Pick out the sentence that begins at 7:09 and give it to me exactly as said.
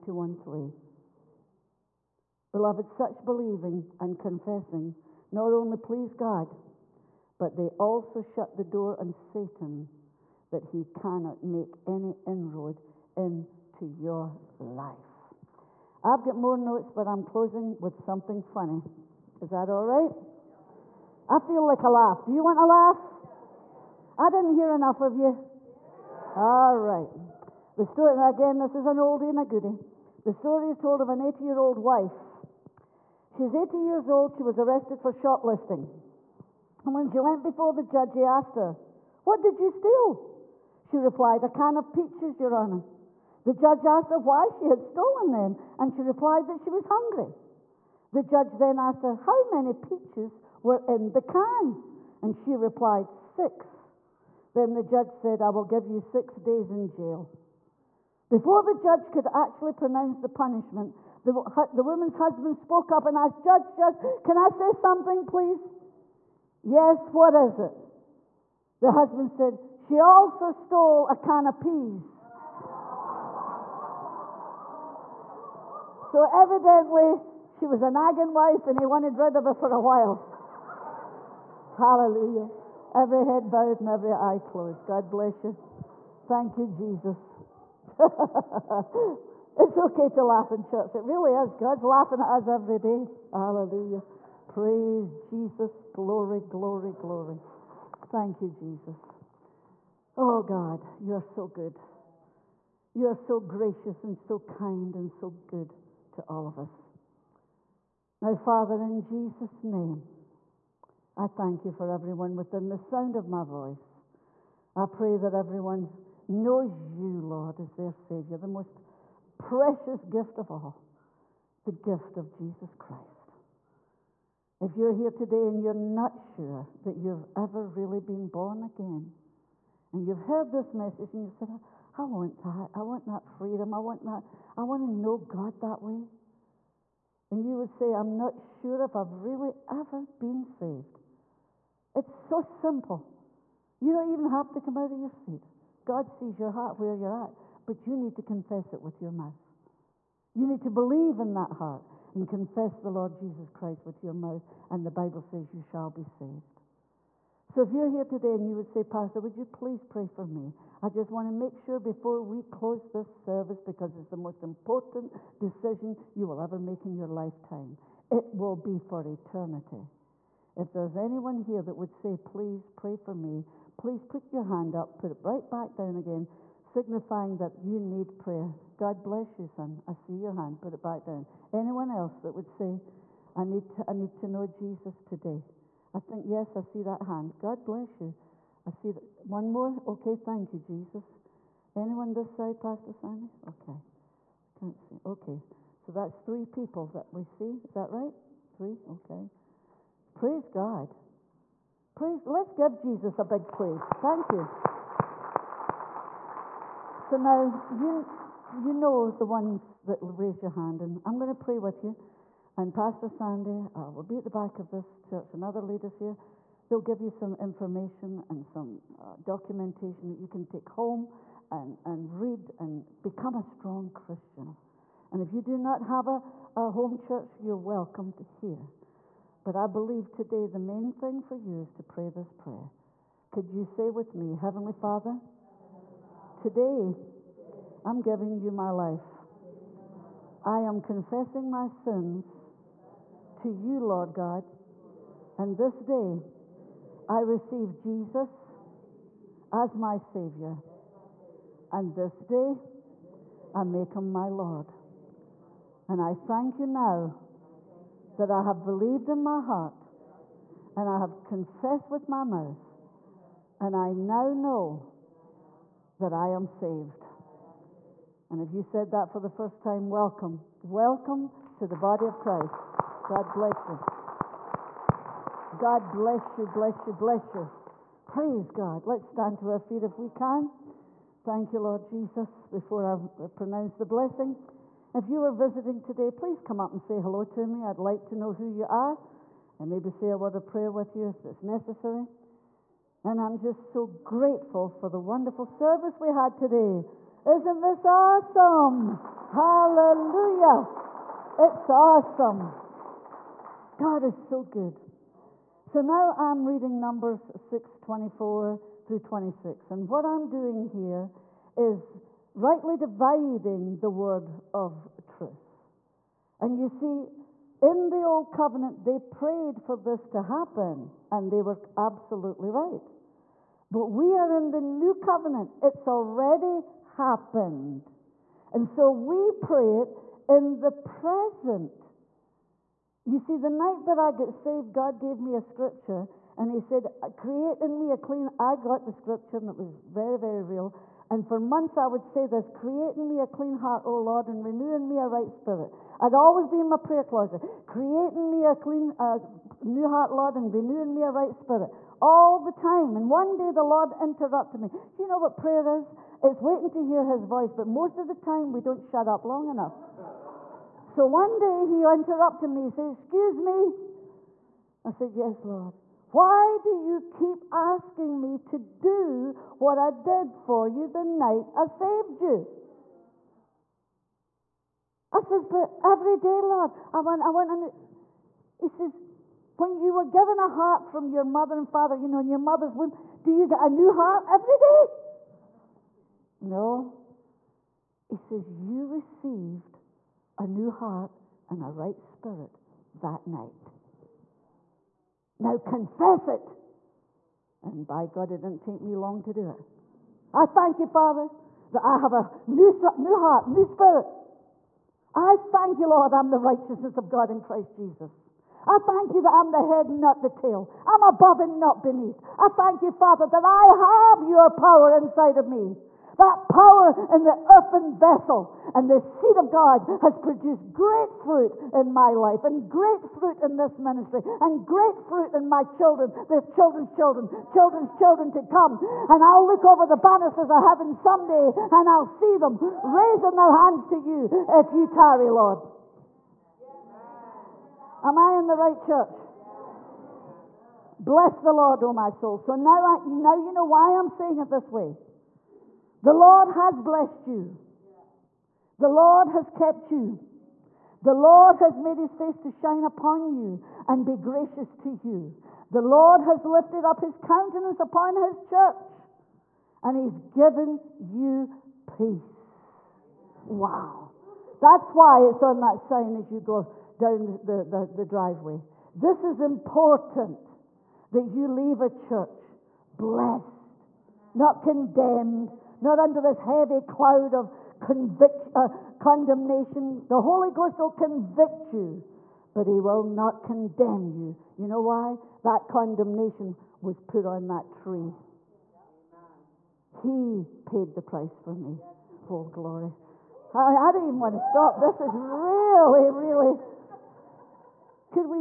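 And I'll look over the banisters of heaven someday and I'll see them raising their hands to you if you tarry, Lord.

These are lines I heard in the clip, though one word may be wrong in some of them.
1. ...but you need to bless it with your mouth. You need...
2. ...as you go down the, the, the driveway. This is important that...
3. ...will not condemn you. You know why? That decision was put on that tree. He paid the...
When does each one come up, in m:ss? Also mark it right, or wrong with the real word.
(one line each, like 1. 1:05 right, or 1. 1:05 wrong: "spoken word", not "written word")
1. 2:27 wrong: "confess", not "bless"
2. 7:46 right
3. 8:02 wrong: "condemnation", not "decision".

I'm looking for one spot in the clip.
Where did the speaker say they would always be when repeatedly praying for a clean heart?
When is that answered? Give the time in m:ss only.
5:46.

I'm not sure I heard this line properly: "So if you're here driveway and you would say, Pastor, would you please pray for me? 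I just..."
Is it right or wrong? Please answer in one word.
wrong.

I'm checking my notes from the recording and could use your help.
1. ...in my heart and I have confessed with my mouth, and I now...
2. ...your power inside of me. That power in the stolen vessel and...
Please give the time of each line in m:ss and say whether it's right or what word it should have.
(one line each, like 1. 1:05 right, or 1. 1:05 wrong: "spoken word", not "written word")
1. 4:19 right
2. 6:54 wrong: "earthen", not "stolen".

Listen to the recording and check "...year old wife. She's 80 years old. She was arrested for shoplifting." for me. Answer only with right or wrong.
right.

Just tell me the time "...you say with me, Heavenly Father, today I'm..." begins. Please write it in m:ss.
3:53.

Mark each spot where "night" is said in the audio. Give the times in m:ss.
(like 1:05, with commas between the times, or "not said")
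5:33, 6:11, 6:33.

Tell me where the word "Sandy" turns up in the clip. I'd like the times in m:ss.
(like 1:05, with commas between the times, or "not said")
3:12, 3:33.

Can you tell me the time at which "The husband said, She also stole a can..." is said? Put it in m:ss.
1:08.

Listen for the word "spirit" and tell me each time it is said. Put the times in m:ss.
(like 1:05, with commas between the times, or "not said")
5:45, 5:51, 6:31, 6:43.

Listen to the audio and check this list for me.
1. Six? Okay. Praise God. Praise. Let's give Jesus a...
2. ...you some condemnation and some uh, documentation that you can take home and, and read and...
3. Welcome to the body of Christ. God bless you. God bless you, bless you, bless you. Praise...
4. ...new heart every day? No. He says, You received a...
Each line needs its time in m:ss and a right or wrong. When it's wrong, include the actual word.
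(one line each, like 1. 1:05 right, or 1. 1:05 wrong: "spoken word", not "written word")
1. 3:18 wrong: "Three", not "Six"
2. 3:37 wrong: "information", not "condemnation"
3. 4:30 right
4. 6:23 right.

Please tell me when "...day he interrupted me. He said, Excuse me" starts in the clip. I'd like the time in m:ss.
6:01.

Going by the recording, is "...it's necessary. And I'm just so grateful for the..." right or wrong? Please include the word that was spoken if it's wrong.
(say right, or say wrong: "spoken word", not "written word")
right.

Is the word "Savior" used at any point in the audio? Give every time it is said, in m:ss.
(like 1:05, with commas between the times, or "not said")
1:57, 4:09.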